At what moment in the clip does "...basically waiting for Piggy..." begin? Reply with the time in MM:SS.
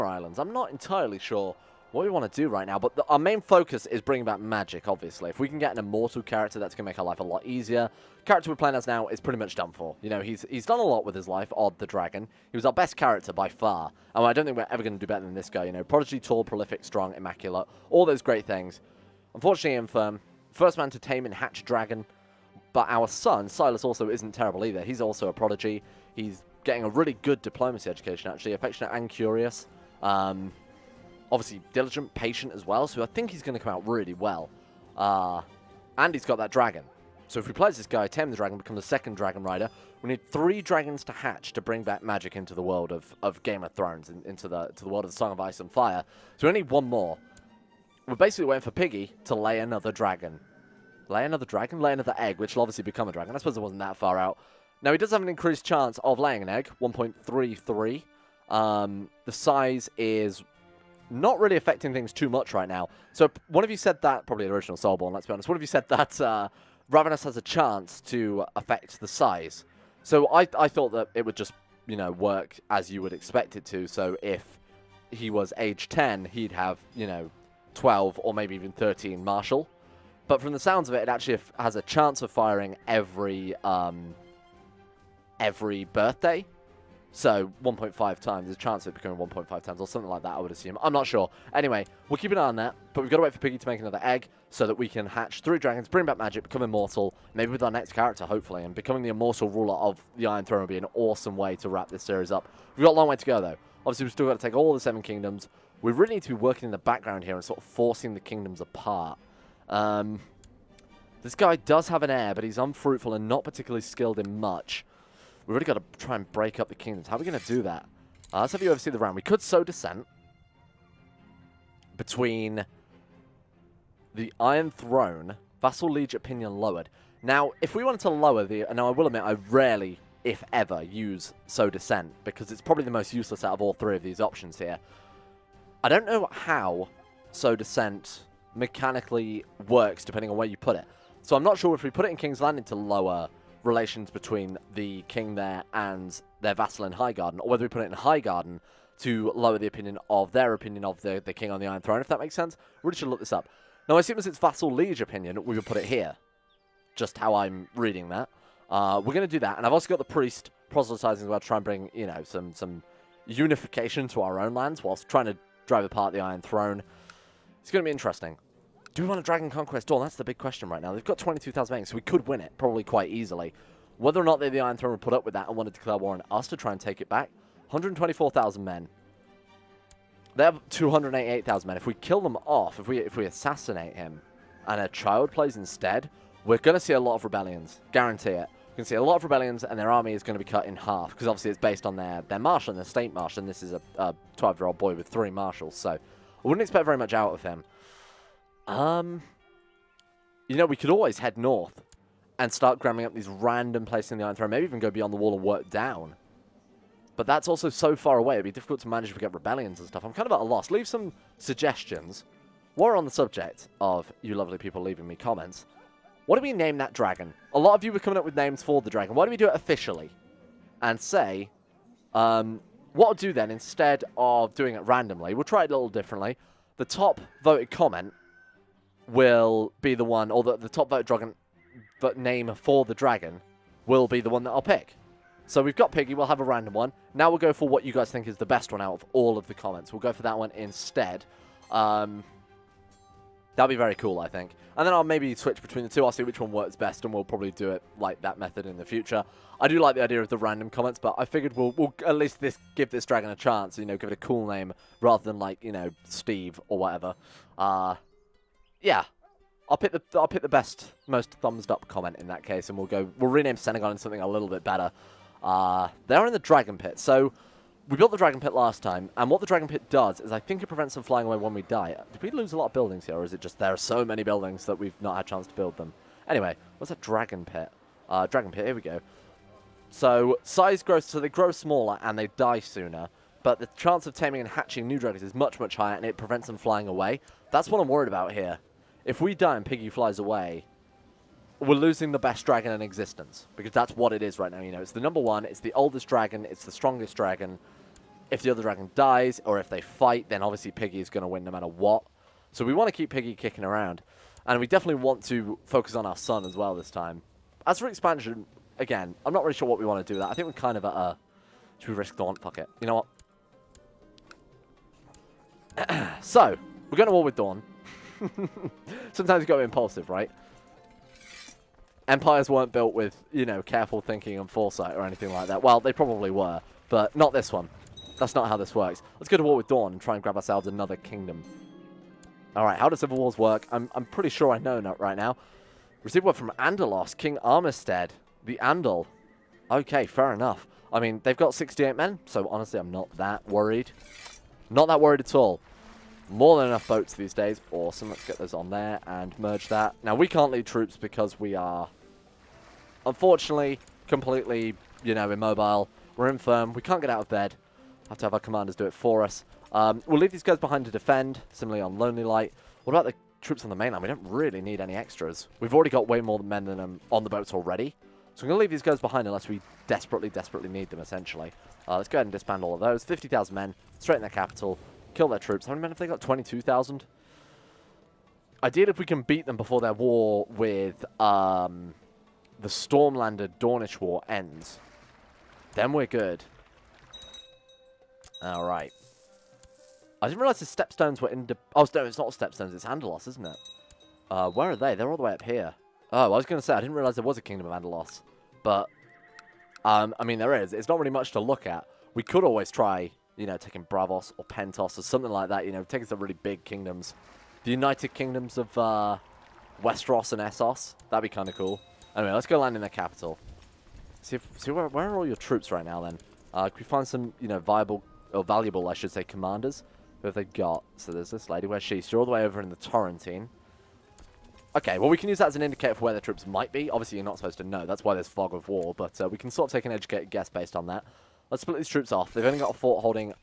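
00:48.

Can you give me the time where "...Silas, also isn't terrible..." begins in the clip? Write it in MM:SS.
00:23.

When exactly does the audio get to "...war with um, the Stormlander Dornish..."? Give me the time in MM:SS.
06:19.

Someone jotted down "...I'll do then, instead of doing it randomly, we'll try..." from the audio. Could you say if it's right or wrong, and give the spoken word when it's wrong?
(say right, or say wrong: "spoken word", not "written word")
right.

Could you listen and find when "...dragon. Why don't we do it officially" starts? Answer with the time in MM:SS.
03:38.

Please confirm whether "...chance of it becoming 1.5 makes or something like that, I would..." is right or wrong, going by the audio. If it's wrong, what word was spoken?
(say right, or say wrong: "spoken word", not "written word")
wrong: "times", not "makes".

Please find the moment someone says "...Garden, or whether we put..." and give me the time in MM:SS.
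02:27.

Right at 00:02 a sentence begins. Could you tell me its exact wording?
But the, our main focus is bringing back magic, obviously.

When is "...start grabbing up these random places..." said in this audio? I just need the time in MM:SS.
03:22.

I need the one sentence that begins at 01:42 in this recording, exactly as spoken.
We've got a long way to go, though.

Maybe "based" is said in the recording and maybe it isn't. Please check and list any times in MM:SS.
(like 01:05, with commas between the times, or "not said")
03:11, 07:10.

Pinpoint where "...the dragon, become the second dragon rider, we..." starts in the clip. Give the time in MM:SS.
00:38.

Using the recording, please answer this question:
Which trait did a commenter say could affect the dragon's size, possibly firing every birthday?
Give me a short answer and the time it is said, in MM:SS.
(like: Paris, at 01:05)
Ravenous, at 01:06.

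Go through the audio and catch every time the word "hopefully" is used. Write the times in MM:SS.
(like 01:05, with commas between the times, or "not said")
01:38.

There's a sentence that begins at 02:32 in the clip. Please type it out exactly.
We really should look this up.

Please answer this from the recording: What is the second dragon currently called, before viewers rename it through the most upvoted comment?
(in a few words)
Senegon.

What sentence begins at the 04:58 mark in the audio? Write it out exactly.
If the other dragon dies, or if they fight, then obviously Piggy is going to win no matter what.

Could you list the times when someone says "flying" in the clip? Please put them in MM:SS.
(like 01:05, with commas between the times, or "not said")
04:31, 04:46.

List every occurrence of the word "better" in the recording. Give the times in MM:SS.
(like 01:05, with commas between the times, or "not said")
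00:15, 04:24.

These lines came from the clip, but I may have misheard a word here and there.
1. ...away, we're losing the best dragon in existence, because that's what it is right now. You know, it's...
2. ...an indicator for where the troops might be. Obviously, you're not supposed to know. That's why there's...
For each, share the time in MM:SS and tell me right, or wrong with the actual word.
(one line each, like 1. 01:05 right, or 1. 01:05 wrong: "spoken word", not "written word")
1. 04:50 right
2. 07:05 right.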